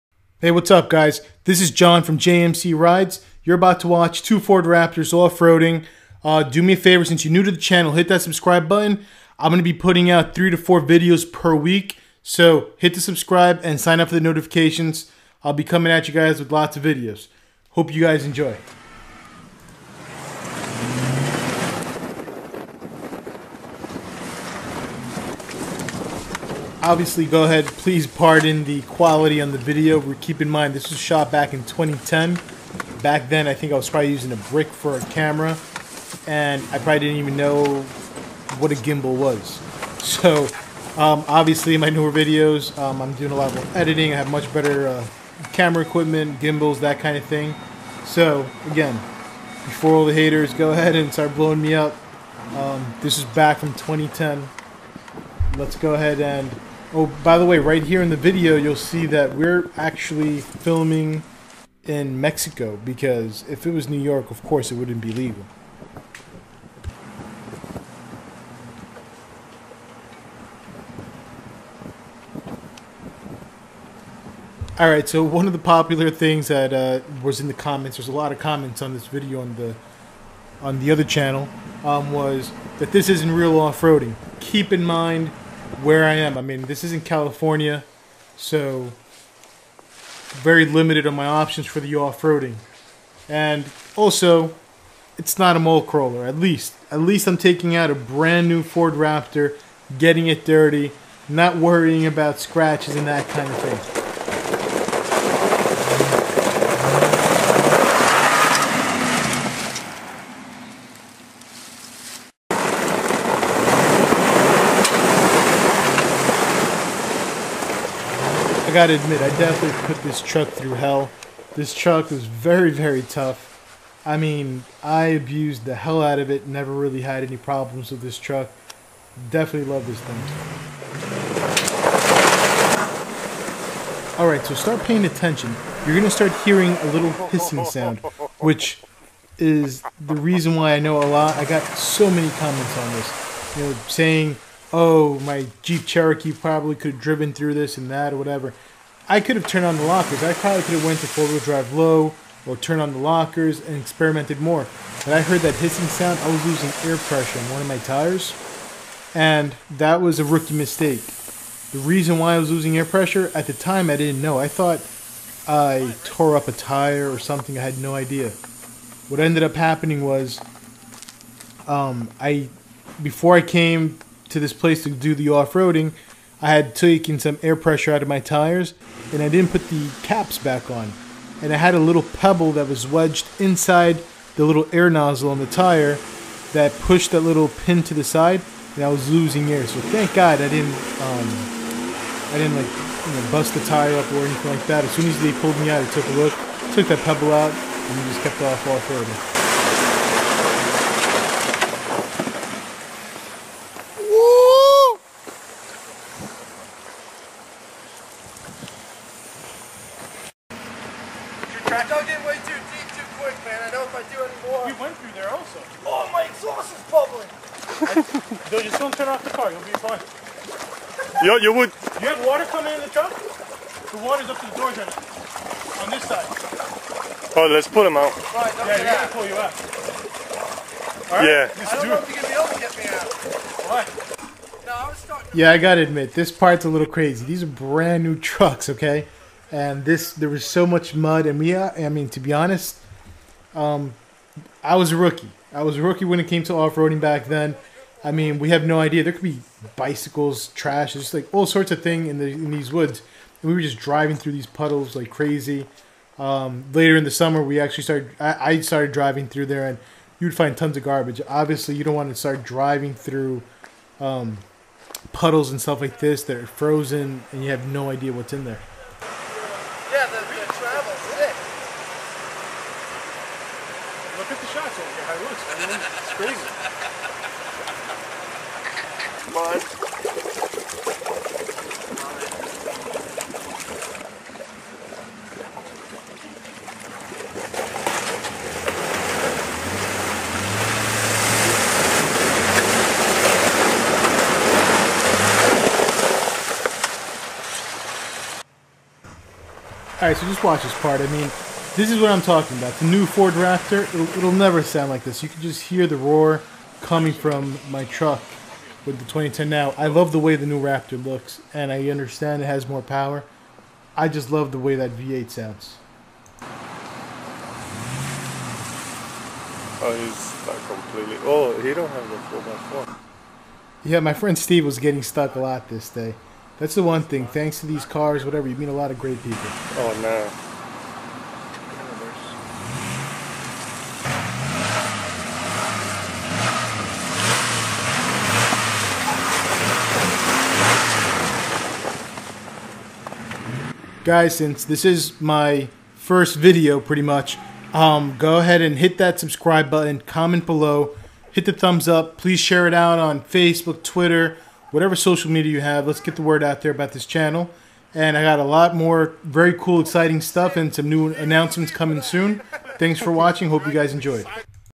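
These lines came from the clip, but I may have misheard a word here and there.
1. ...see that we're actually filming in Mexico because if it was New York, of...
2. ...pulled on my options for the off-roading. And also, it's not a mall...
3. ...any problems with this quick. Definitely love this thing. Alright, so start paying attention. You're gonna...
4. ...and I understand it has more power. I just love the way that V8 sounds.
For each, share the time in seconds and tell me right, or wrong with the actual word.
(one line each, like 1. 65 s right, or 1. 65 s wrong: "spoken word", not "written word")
1. 58 s right
2. 90 s wrong: "limited", not "pulled"
3. 127 s wrong: "truck", not "quick"
4. 311 s right.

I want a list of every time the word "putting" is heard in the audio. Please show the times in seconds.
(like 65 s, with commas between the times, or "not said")
9 s.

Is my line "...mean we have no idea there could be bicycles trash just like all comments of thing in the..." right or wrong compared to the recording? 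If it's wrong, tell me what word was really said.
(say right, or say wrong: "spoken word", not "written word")
wrong: "sorts", not "comments".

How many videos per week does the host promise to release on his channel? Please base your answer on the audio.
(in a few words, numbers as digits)
3 to 4.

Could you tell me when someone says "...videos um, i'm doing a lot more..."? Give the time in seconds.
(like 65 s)
42 s.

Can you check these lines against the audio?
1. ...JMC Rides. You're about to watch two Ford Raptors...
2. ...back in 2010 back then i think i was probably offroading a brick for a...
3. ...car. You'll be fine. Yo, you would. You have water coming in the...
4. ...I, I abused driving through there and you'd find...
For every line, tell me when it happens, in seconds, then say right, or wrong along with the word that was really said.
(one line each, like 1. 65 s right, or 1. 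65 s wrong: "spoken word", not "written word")
1. 2 s right
2. 31 s wrong: "using", not "offroading"
3. 219 s right
4. 258 s wrong: "started", not "abused".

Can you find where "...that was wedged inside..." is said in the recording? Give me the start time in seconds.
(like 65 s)
182 s.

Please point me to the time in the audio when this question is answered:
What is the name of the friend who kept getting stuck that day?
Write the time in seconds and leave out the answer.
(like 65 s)
324 s.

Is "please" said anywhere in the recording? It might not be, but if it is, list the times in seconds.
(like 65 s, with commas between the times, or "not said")
27 s, 352 s.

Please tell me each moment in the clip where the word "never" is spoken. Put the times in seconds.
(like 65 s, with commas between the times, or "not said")
126 s, 304 s.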